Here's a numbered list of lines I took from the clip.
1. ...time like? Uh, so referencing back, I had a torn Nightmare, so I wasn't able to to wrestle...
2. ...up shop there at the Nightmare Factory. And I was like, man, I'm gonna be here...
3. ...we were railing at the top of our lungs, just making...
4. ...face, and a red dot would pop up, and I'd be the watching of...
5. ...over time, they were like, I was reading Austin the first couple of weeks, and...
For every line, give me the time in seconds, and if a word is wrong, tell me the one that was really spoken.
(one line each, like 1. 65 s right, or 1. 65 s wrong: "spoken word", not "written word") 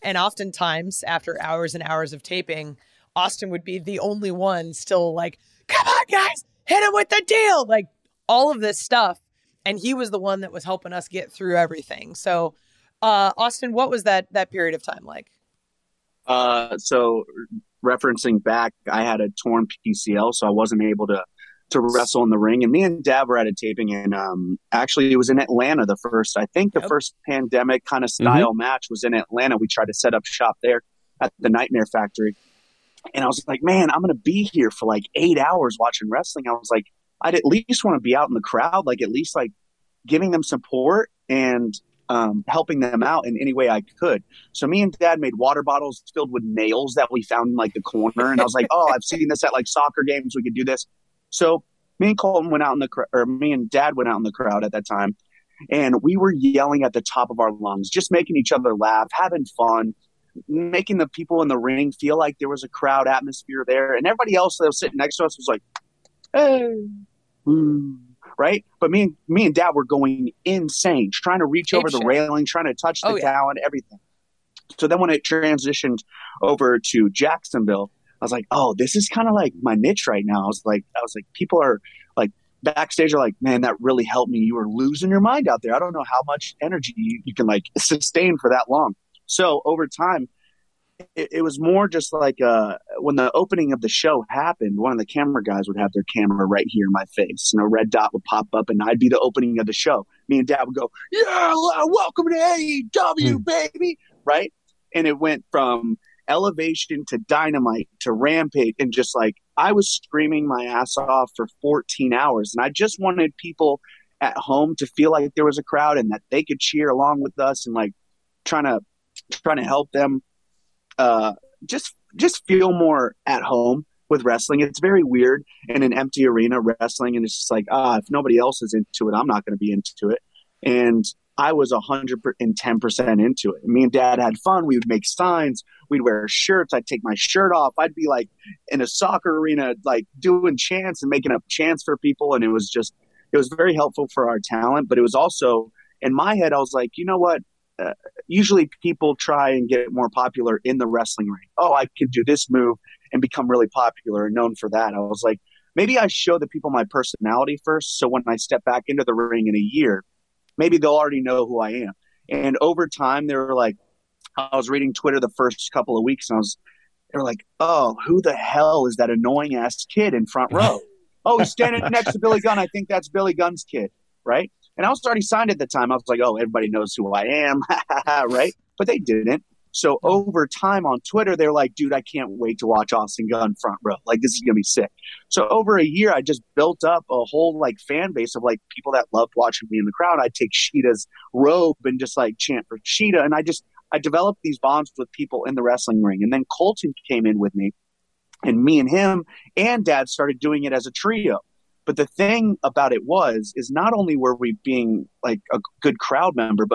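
1. 14 s wrong: "PCL", not "Nightmare"
2. 30 s right
3. 56 s wrong: "yelling", not "railing"
4. 97 s wrong: "opening", not "watching"
5. 162 s wrong: "Twitter", not "Austin".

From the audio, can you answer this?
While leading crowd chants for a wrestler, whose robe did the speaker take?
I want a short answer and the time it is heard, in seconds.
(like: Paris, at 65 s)
Shida, at 190 s.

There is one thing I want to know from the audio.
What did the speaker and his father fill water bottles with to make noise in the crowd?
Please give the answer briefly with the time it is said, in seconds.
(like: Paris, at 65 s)
nails, at 46 s.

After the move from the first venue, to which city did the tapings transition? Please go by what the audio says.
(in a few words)
Jacksonville.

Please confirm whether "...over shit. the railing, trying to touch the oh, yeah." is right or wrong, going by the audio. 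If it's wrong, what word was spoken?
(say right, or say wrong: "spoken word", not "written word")
right.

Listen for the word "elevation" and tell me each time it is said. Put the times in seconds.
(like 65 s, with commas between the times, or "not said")
106 s.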